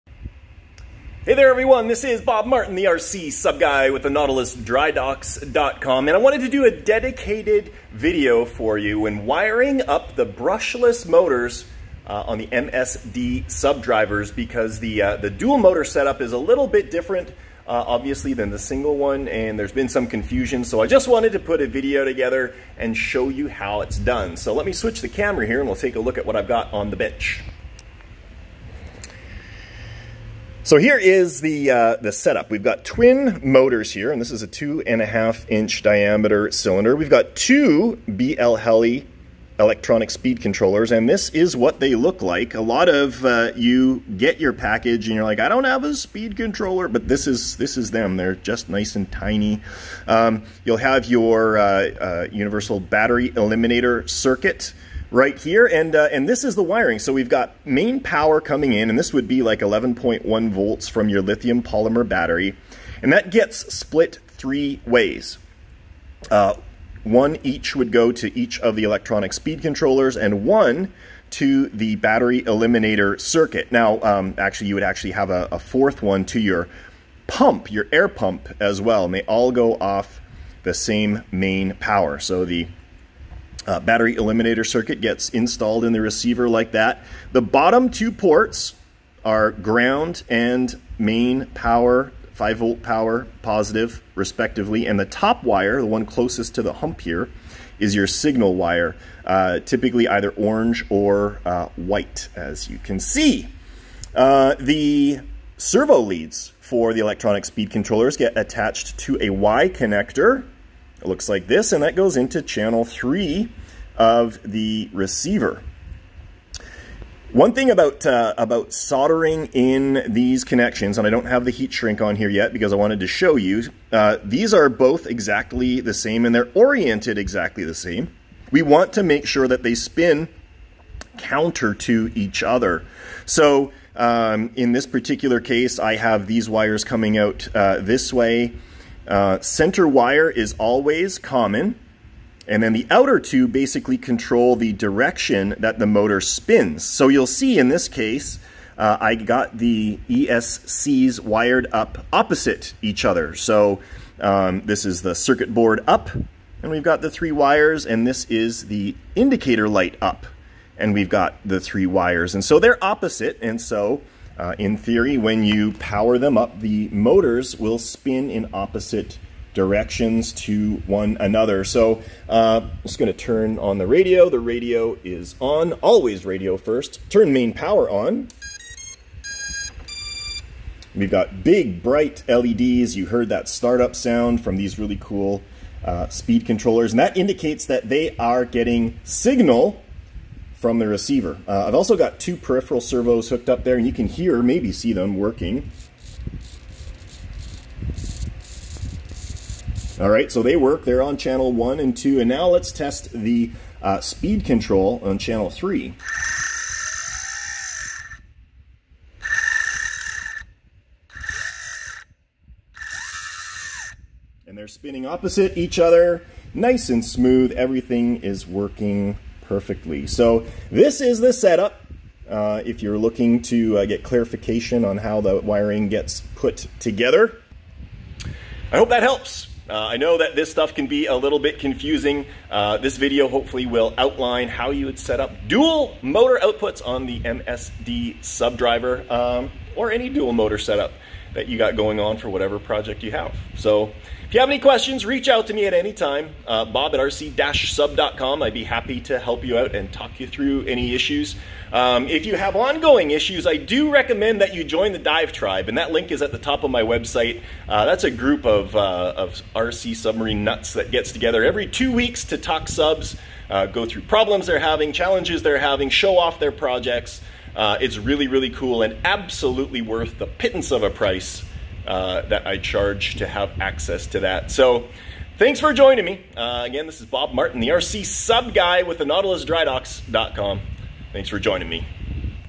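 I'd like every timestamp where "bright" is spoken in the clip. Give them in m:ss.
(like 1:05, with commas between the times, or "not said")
3:01.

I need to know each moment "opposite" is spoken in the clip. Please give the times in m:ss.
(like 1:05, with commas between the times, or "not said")
2:32, 2:42, 2:48, 3:35.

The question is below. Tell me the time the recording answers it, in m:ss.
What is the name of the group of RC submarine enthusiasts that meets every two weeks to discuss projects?
4:14.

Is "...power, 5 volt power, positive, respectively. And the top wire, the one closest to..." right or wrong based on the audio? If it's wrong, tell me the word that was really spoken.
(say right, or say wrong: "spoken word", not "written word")
right.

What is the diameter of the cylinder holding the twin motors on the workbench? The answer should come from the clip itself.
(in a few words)
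2.5 inches.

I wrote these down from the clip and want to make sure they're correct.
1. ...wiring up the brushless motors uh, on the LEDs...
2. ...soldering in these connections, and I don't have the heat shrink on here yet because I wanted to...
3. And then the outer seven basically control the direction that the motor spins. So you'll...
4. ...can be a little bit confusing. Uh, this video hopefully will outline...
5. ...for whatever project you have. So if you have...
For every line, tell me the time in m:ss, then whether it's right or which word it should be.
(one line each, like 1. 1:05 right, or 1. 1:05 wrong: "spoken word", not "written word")
1. 0:09 wrong: "MSD", not "LEDs"
2. 1:58 right
3. 2:22 wrong: "two", not "seven"
4. 3:50 right
5. 4:02 right.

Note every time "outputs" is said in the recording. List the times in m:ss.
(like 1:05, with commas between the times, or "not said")
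3:56.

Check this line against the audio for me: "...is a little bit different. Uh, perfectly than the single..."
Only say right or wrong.
wrong.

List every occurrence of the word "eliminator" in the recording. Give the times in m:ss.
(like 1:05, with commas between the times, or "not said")
0:53, 1:12, 1:24.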